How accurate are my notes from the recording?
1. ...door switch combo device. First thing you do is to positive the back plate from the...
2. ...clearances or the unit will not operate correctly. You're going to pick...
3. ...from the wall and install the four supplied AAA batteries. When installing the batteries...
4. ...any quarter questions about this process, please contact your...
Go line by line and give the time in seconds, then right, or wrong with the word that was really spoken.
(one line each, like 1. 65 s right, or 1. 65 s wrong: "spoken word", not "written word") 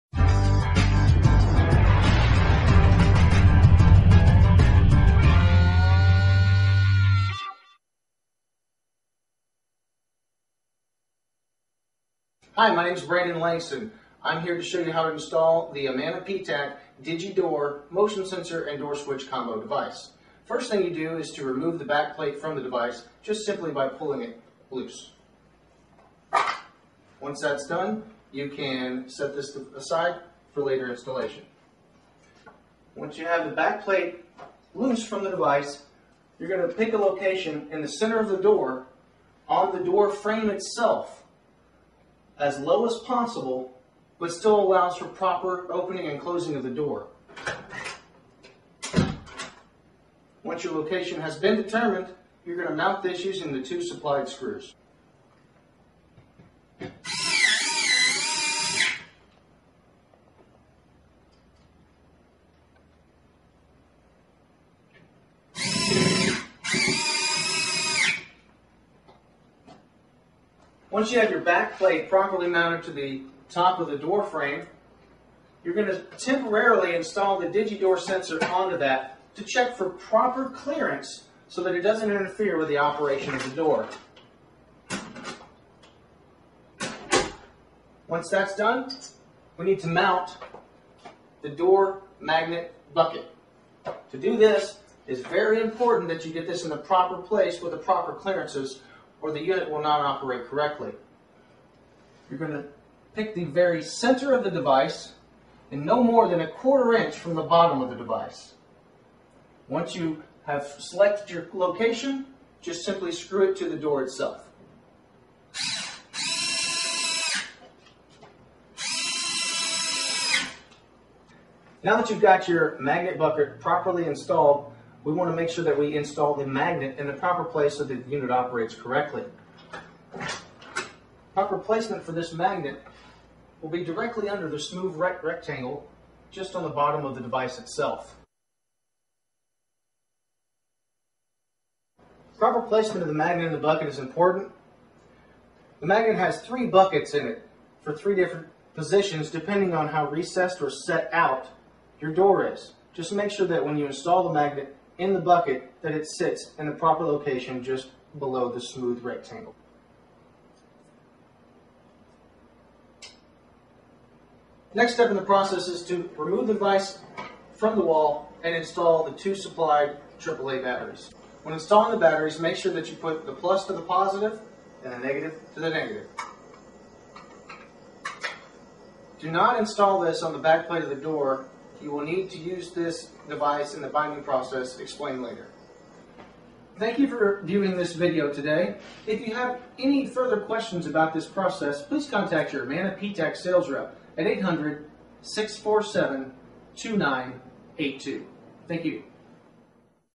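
1. 18 s wrong: "remove", not "positive"
2. 98 s right
3. 167 s wrong: "two", not "four"
4. 189 s wrong: "further", not "quarter".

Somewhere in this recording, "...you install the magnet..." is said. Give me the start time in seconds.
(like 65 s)
153 s.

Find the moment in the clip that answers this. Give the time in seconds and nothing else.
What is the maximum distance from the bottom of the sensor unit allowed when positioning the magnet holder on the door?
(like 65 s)
106 s.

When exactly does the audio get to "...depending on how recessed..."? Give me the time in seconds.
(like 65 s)
149 s.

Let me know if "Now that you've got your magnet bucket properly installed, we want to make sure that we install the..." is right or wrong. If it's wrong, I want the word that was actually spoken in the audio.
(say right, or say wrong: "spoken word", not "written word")
right.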